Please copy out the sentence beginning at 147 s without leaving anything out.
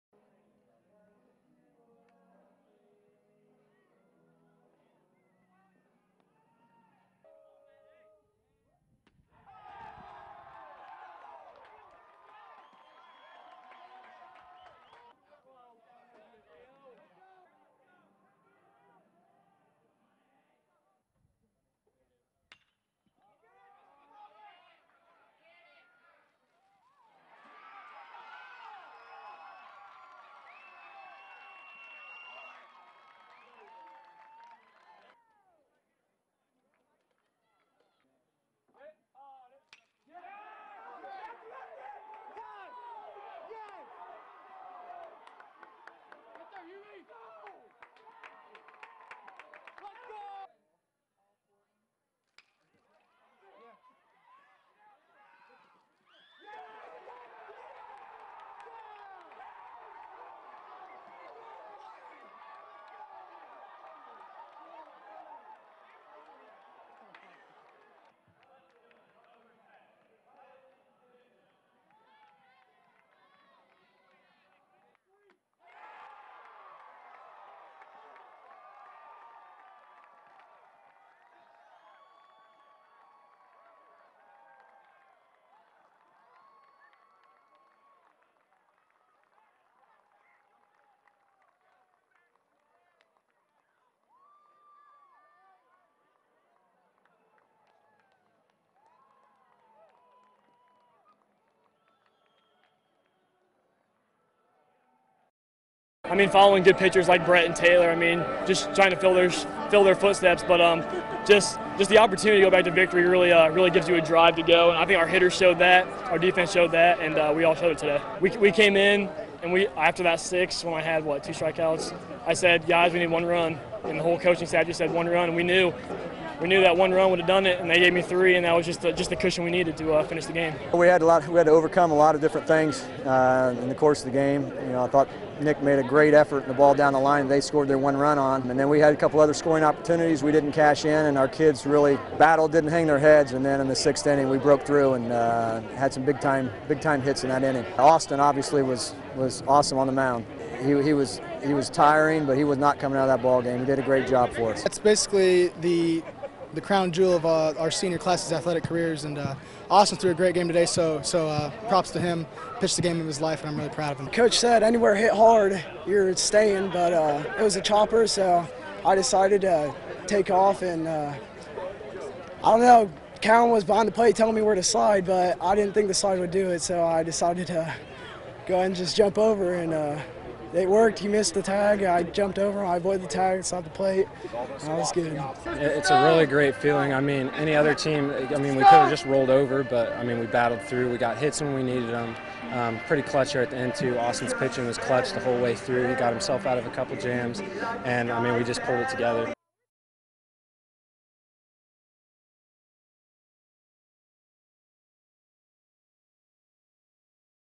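Austin obviously was was awesome on the mound.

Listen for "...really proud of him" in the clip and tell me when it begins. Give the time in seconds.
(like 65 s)
163 s.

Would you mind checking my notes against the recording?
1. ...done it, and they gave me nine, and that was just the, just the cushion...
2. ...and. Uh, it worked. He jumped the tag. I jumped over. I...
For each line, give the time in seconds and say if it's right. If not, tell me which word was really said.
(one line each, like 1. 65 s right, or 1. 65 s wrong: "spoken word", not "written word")
1. 127 s wrong: "three", not "nine"
2. 179 s wrong: "missed", not "jumped".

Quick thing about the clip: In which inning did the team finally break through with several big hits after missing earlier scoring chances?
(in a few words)
sixth.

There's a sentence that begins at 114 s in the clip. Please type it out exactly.
And I think our hitters showed that, our defense showed that, and uh, we all showed it today.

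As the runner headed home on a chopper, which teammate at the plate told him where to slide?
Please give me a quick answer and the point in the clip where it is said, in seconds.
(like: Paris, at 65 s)
Cowan, at 173 s.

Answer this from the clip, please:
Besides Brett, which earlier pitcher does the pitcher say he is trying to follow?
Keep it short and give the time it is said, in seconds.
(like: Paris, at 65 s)
Taylor, at 107 s.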